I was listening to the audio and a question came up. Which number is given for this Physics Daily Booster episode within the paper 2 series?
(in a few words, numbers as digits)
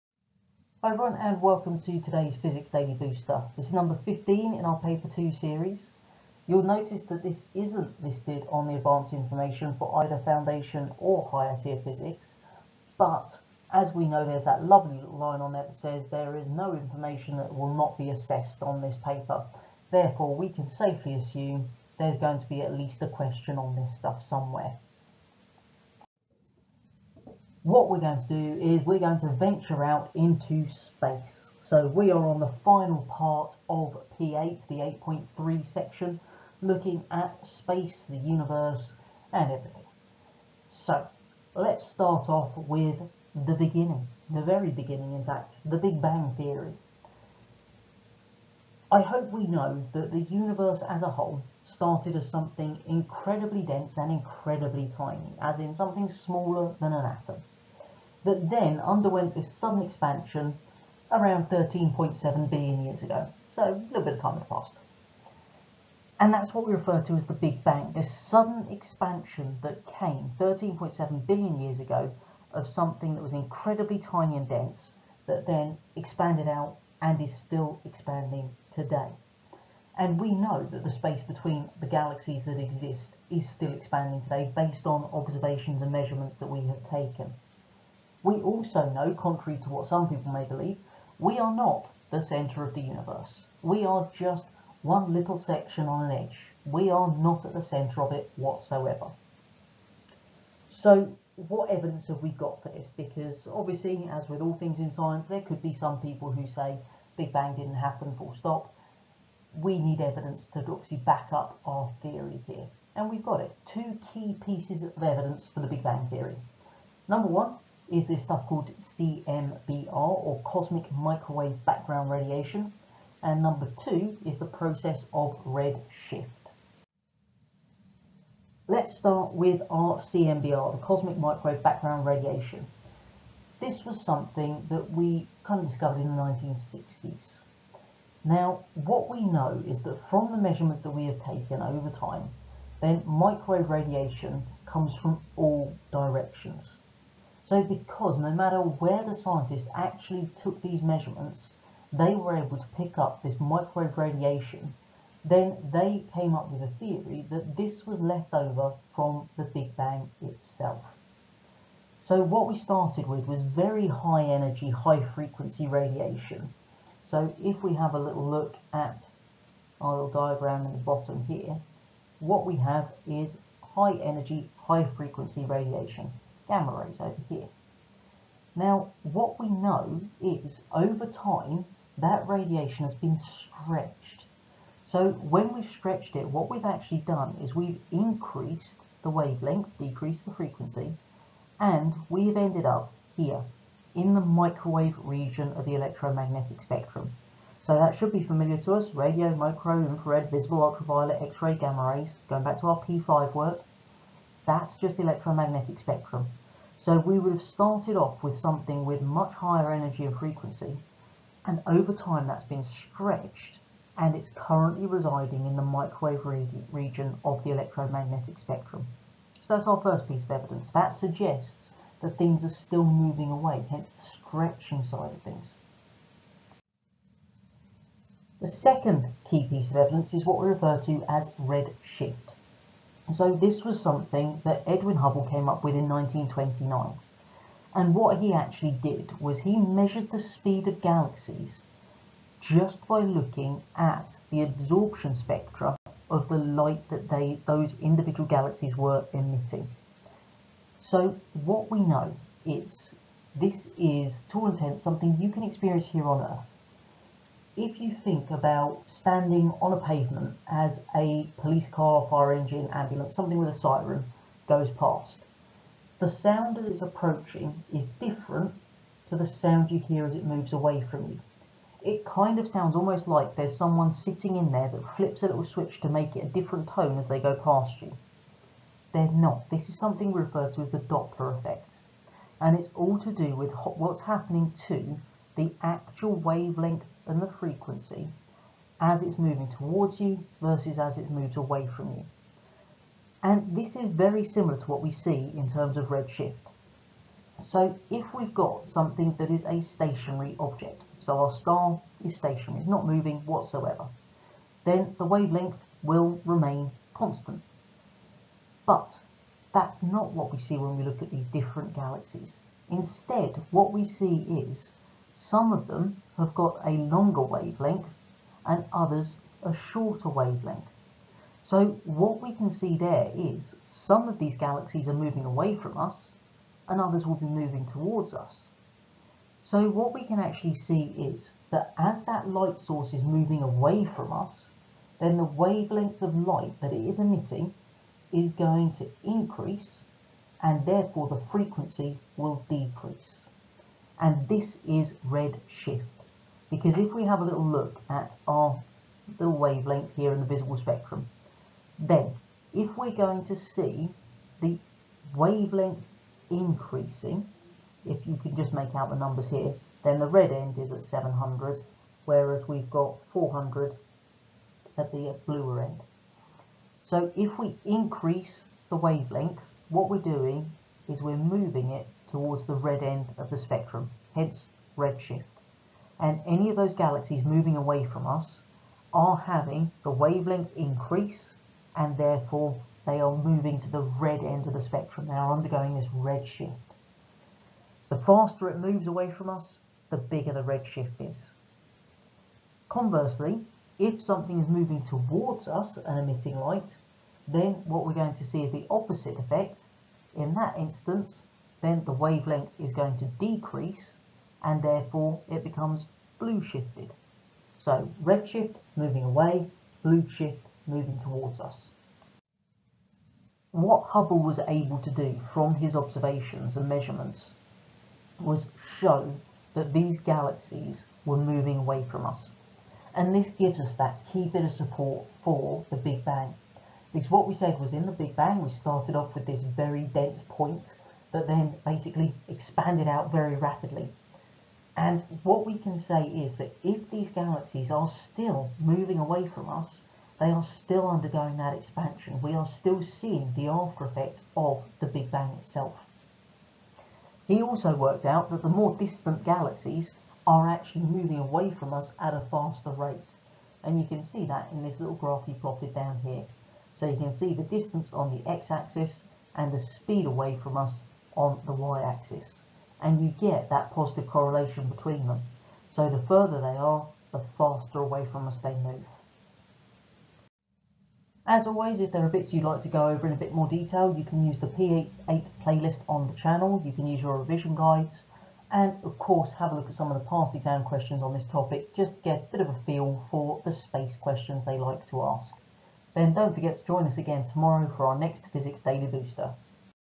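15.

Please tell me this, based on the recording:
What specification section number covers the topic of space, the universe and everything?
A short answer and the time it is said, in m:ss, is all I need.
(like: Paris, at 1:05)
8.3, at 0:35.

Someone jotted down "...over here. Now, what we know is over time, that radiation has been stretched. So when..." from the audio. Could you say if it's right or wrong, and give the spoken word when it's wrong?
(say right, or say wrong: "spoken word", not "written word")
right.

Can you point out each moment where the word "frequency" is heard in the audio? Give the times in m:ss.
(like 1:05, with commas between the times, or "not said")
2:45, 2:54, 3:10, 3:30, 4:47, 5:41.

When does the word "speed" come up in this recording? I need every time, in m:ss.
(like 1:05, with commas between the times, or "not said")
4:00, 7:39.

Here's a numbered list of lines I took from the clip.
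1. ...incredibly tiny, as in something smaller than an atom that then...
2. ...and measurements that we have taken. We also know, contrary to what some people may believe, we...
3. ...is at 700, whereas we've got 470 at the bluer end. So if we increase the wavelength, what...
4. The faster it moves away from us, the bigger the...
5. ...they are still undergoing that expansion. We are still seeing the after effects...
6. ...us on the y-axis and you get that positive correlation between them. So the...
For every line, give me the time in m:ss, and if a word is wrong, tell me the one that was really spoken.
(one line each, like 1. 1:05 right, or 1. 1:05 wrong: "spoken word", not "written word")
1. 0:54 right
2. 1:25 right
3. 6:00 wrong: "400", not "470"
4. 6:27 right
5. 7:20 right
6. 7:40 right.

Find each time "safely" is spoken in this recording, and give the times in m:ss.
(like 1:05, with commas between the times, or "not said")
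0:20.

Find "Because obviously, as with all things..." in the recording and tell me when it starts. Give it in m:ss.
1:42.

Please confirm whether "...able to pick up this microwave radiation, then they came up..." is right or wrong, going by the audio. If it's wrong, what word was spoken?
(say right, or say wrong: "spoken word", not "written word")
right.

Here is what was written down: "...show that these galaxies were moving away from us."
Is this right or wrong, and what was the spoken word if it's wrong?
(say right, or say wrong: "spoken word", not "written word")
right.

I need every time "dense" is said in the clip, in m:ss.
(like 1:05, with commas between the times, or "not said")
0:53, 1:14, 7:09.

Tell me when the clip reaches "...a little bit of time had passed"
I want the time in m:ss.
1:03.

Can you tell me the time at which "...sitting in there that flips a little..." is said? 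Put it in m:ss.
4:33.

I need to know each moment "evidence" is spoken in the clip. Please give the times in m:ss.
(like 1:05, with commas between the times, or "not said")
1:41, 1:50, 1:55, 3:40, 3:49.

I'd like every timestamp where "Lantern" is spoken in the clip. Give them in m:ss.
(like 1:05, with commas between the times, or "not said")
not said.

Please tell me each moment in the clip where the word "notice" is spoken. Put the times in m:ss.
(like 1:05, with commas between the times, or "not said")
0:06.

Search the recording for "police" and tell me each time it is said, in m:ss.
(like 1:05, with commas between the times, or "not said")
4:21.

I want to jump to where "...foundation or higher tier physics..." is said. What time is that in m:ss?
0:10.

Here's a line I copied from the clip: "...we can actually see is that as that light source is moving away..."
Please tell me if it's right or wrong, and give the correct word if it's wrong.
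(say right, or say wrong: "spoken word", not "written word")
right.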